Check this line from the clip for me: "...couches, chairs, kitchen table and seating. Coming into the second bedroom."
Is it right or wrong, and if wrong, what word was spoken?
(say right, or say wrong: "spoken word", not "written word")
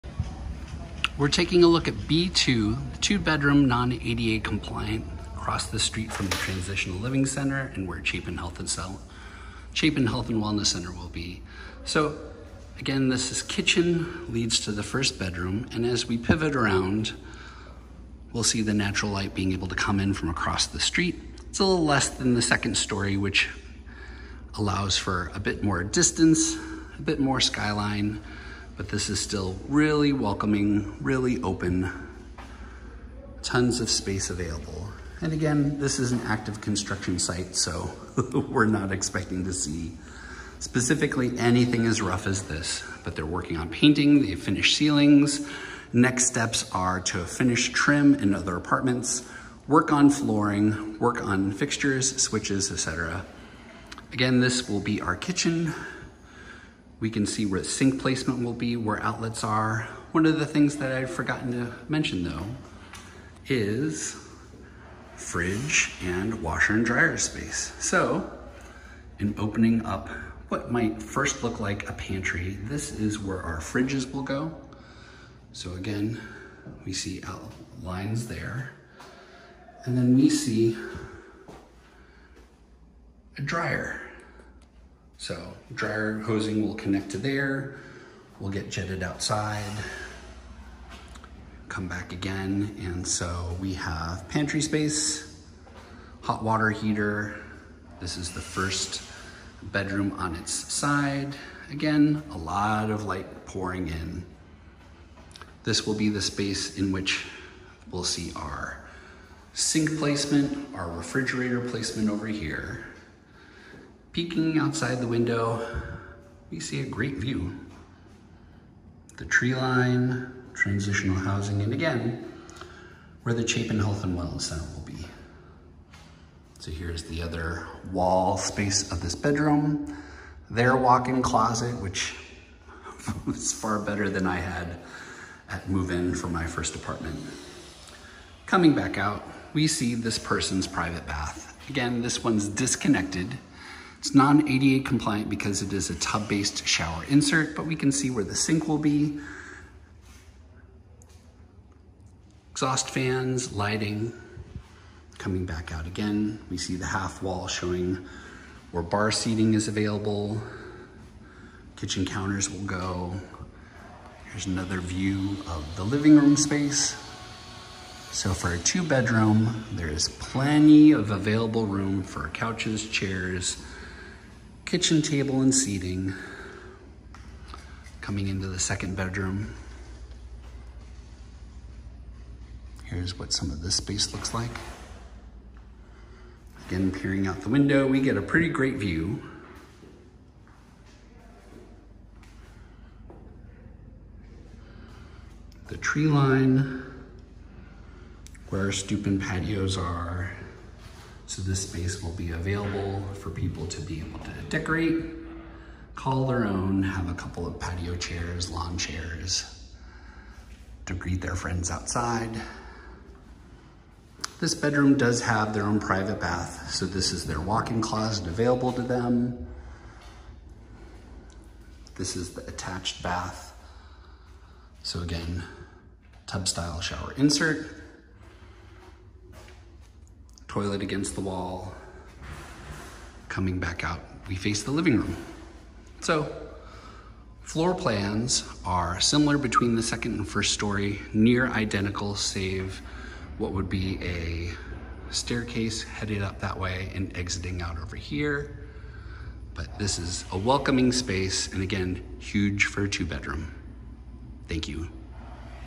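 right.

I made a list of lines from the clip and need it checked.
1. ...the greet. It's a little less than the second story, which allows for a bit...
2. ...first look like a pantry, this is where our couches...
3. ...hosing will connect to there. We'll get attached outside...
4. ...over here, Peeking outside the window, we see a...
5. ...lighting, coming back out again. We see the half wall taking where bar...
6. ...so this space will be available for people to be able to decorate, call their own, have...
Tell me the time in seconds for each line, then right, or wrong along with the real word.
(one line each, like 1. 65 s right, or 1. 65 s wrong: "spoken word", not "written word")
1. 20 s wrong: "street", not "greet"
2. 71 s wrong: "fridges", not "couches"
3. 86 s wrong: "jetted", not "attached"
4. 112 s right
5. 153 s wrong: "showing", not "taking"
6. 201 s right.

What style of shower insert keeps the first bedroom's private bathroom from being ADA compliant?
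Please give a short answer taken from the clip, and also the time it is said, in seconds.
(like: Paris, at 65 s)
tub-based, at 145 s.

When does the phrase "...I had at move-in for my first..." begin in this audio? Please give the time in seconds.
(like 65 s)
134 s.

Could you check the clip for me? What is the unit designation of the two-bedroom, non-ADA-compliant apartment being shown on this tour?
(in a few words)
B2.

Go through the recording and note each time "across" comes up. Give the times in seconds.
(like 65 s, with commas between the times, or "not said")
5 s, 20 s.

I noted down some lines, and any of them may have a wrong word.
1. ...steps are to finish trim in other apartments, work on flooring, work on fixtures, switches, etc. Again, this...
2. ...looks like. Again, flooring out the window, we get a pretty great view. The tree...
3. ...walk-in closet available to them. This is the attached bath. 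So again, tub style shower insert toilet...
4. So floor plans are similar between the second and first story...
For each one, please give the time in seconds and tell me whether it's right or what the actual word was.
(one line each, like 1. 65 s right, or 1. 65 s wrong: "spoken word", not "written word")
1. 46 s right
2. 184 s wrong: "peering", not "flooring"
3. 217 s right
4. 236 s right.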